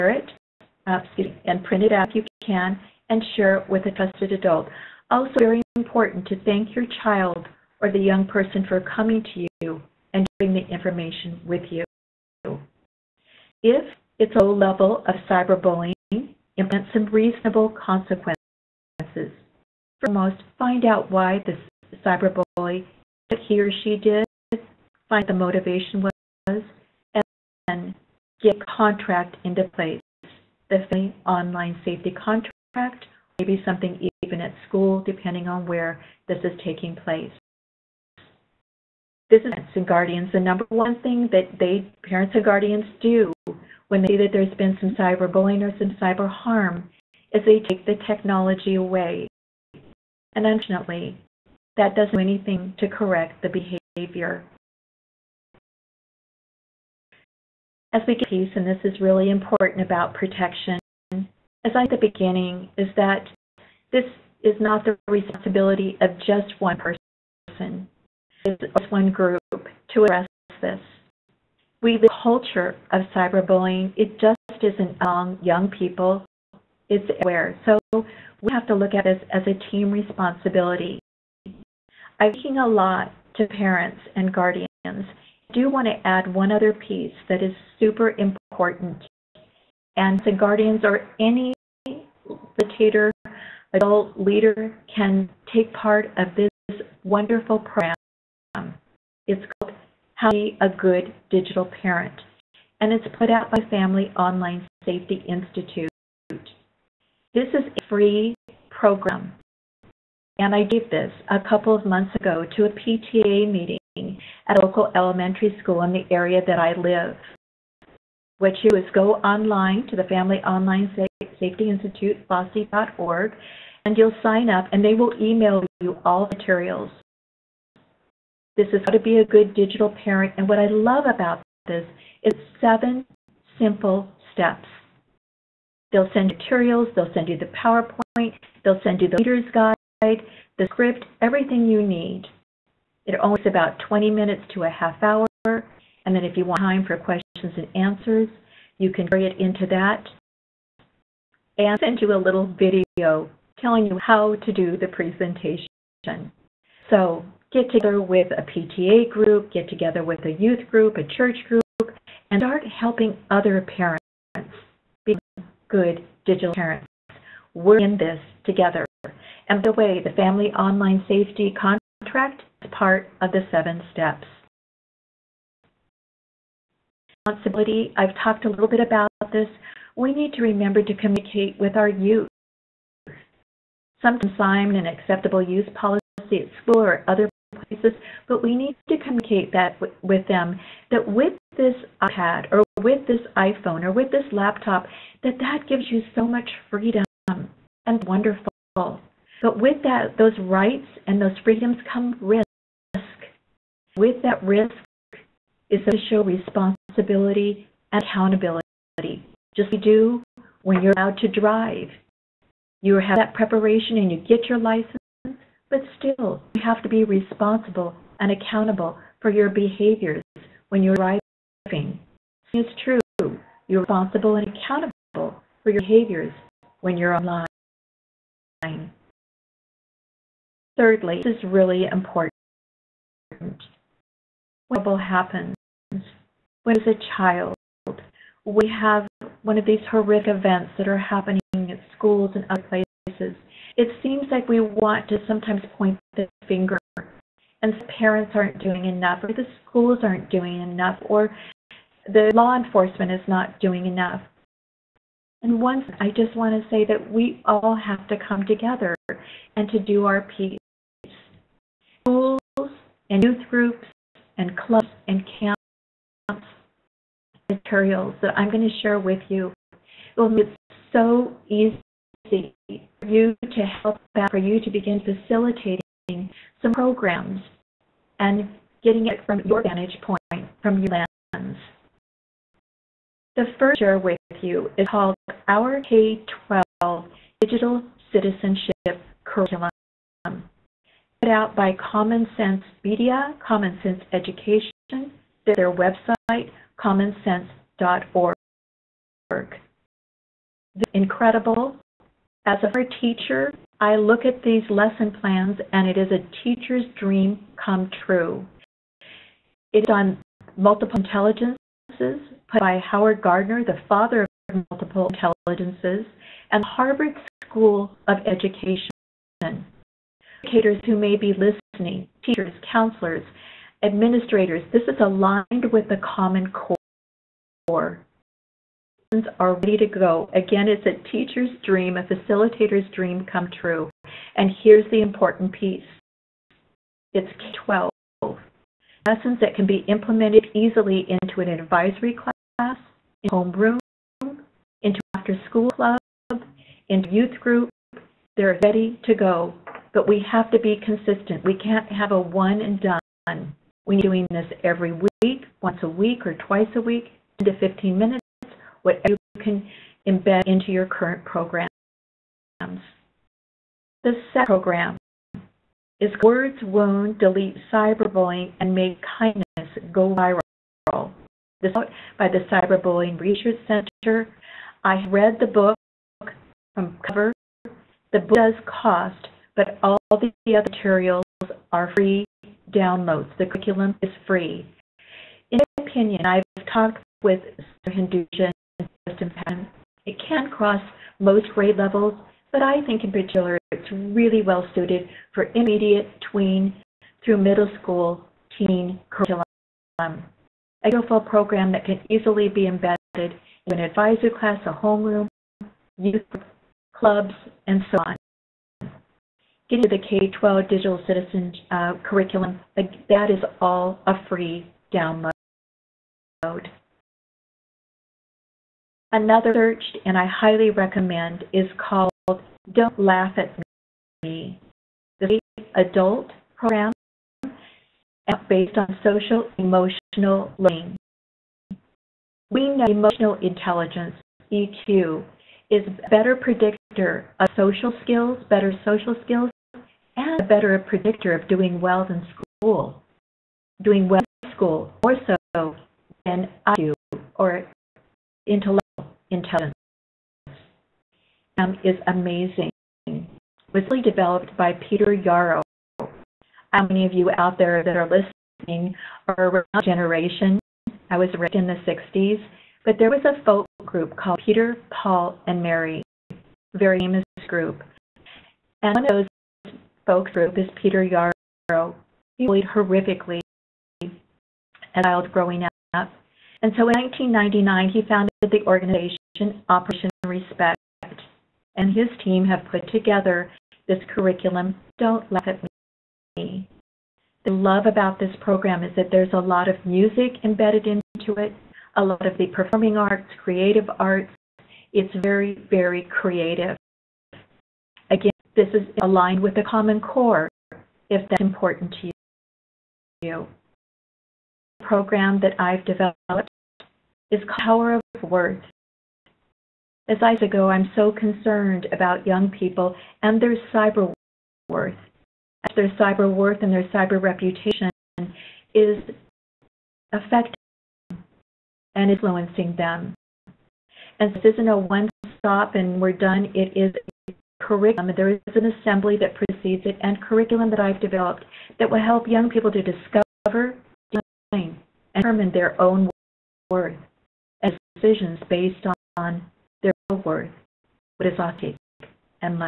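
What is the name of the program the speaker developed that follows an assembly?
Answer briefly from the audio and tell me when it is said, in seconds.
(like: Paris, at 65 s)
Power of Words, at 507 s.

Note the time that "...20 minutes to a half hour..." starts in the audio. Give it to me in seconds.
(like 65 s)
143 s.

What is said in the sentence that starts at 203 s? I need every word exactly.
With that risk is to show responsibility and accountability.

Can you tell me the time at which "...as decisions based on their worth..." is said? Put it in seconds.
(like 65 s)
537 s.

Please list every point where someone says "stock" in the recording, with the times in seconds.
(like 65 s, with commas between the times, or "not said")
not said.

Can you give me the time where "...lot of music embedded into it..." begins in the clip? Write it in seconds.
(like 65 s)
489 s.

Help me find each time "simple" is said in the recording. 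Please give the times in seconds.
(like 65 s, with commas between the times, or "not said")
133 s.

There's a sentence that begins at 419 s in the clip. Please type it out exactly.
Another searched and I highly recommend is called Don't Laugh at Me, the adult program based on social emotional learning.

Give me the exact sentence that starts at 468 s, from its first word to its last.
And one of those spoke group is Peter Yarrow.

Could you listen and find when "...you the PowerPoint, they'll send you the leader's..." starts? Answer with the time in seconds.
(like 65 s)
137 s.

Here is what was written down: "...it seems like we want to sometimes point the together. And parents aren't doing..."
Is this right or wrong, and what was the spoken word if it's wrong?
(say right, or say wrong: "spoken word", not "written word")
wrong: "finger", not "together".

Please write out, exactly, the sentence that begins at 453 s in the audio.
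It was really developed by Peter Yarrow.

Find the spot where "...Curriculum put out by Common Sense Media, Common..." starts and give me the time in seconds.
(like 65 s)
289 s.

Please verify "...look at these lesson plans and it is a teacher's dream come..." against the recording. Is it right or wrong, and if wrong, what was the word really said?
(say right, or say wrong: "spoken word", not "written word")
right.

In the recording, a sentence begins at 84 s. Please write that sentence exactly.
I do want to add one other piece that is super important.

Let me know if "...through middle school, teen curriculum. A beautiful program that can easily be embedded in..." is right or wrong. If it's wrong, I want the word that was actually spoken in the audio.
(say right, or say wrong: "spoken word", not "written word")
right.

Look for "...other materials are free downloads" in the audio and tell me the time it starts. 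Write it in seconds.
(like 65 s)
380 s.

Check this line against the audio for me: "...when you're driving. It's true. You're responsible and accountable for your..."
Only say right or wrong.
right.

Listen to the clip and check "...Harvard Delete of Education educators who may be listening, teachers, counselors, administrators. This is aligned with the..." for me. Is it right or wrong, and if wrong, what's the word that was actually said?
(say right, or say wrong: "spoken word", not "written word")
wrong: "School", not "Delete".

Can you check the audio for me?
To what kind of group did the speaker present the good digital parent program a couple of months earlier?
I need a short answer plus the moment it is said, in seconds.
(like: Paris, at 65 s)
PTA meeting, at 112 s.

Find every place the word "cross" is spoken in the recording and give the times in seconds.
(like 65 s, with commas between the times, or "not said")
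390 s.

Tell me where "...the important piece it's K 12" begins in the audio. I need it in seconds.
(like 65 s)
334 s.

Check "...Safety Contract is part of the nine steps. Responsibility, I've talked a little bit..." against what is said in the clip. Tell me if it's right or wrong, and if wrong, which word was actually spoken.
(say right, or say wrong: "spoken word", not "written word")
wrong: "seven", not "nine".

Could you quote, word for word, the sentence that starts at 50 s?
And unfortunately, that doesn't do anything to correct the behavior.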